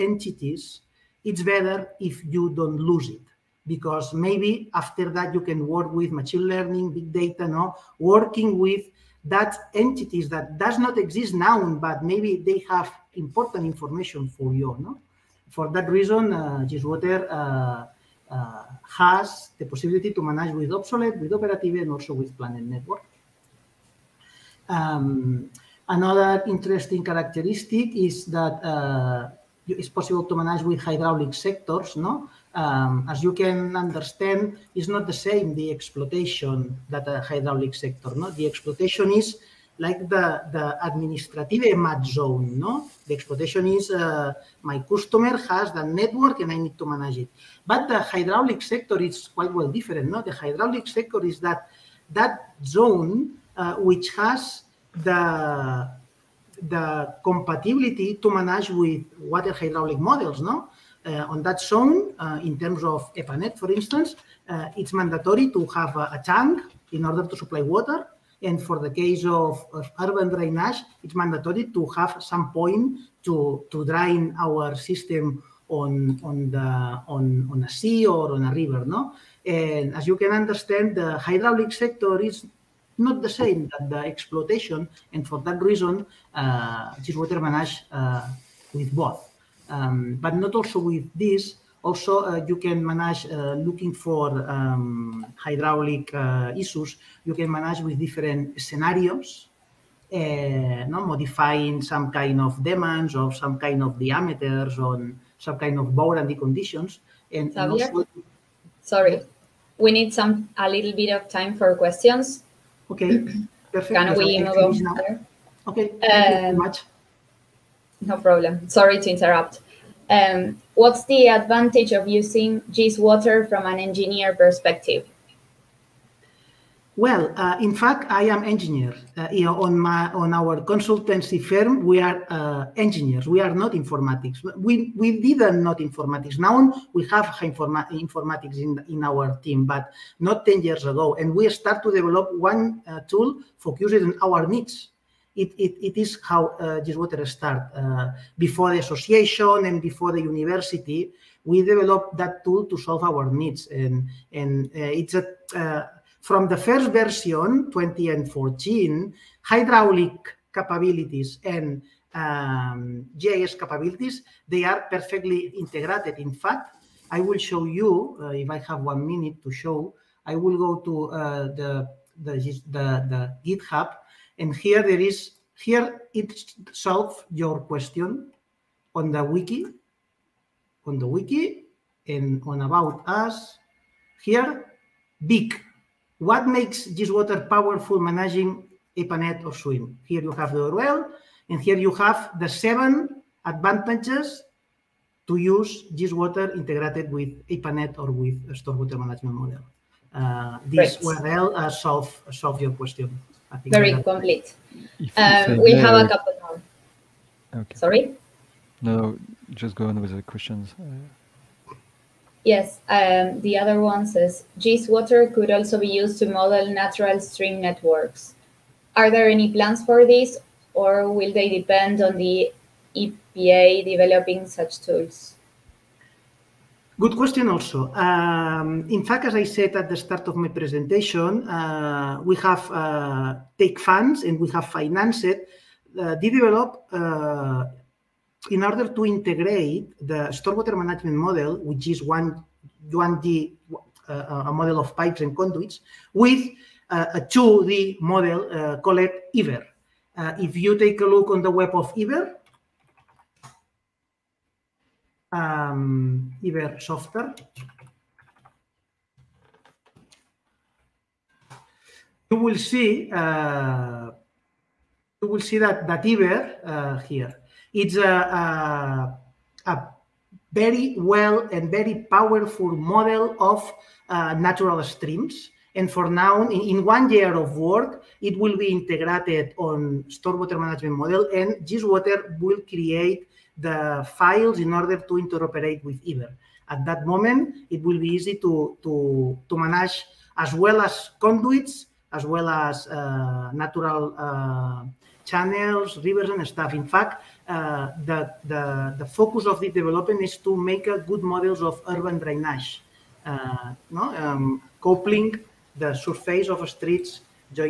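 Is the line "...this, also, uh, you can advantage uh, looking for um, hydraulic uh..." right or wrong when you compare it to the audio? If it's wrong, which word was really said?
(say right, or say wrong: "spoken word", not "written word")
wrong: "manage", not "advantage".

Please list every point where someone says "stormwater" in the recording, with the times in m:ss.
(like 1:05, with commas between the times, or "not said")
3:18, 4:00, 4:40.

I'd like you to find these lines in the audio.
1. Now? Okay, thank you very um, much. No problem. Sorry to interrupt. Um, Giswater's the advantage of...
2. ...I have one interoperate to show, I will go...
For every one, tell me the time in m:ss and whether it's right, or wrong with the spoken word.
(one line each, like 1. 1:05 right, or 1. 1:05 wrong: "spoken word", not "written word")
1. 1:54 wrong: "What", not "Giswater"
2. 2:48 wrong: "minute", not "interoperate".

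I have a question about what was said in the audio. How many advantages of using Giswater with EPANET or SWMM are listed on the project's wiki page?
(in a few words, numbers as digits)
7.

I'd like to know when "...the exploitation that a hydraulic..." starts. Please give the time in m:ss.
0:35.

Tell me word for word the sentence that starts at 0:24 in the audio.
Um, another interesting characteristic is that uh, it's possible to manage with hydraulic sectors, no?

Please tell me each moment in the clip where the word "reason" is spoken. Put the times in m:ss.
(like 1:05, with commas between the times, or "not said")
0:15, 1:25.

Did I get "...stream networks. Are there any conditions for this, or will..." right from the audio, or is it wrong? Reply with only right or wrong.
wrong.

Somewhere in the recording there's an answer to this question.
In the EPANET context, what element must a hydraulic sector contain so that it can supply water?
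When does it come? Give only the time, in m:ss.
1:06.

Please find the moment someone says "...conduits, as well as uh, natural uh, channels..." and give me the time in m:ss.
4:51.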